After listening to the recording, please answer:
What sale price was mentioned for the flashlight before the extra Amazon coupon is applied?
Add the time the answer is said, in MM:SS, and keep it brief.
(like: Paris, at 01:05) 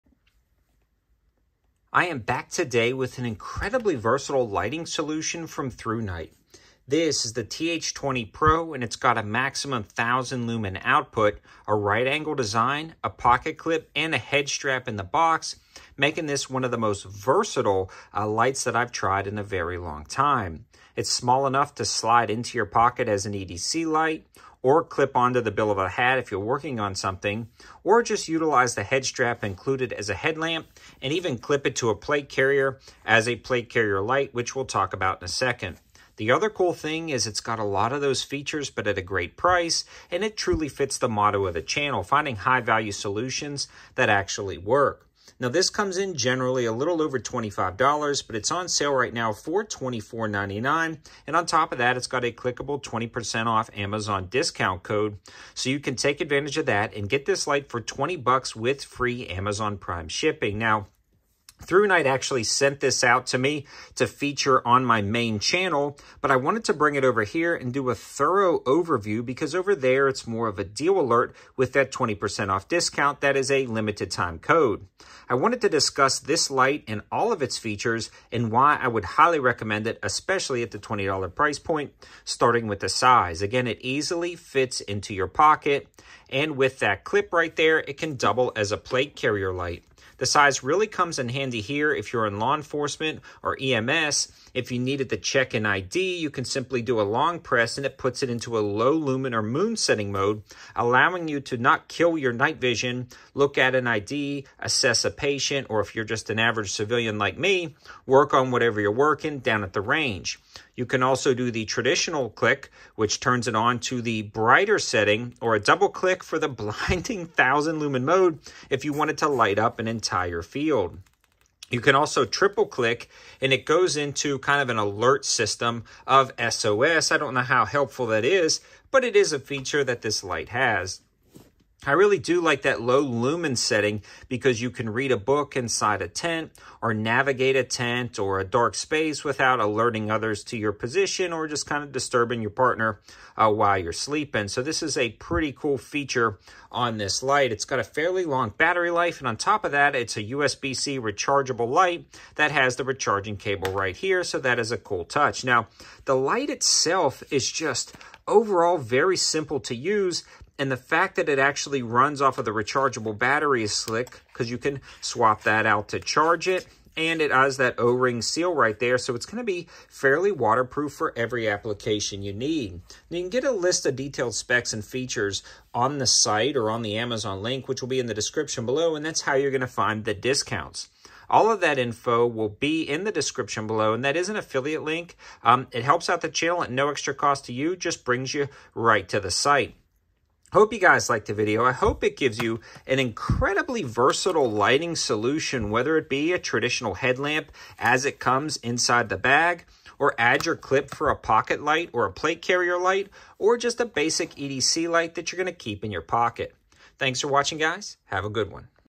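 $24.99, at 00:49.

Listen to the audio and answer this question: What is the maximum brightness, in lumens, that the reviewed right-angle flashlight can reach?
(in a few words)
1000.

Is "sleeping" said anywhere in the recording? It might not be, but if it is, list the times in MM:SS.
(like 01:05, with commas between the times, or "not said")
02:23.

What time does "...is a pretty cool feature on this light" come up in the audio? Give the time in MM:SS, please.
02:24.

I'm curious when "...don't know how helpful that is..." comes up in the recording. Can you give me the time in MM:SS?
02:07.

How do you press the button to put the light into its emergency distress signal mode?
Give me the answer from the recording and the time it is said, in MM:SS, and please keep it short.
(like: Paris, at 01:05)
triple click, at 02:02.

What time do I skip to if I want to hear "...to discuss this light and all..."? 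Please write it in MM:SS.
01:15.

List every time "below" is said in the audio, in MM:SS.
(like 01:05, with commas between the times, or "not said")
02:58, 03:03.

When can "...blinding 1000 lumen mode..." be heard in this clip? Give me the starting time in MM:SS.
01:56.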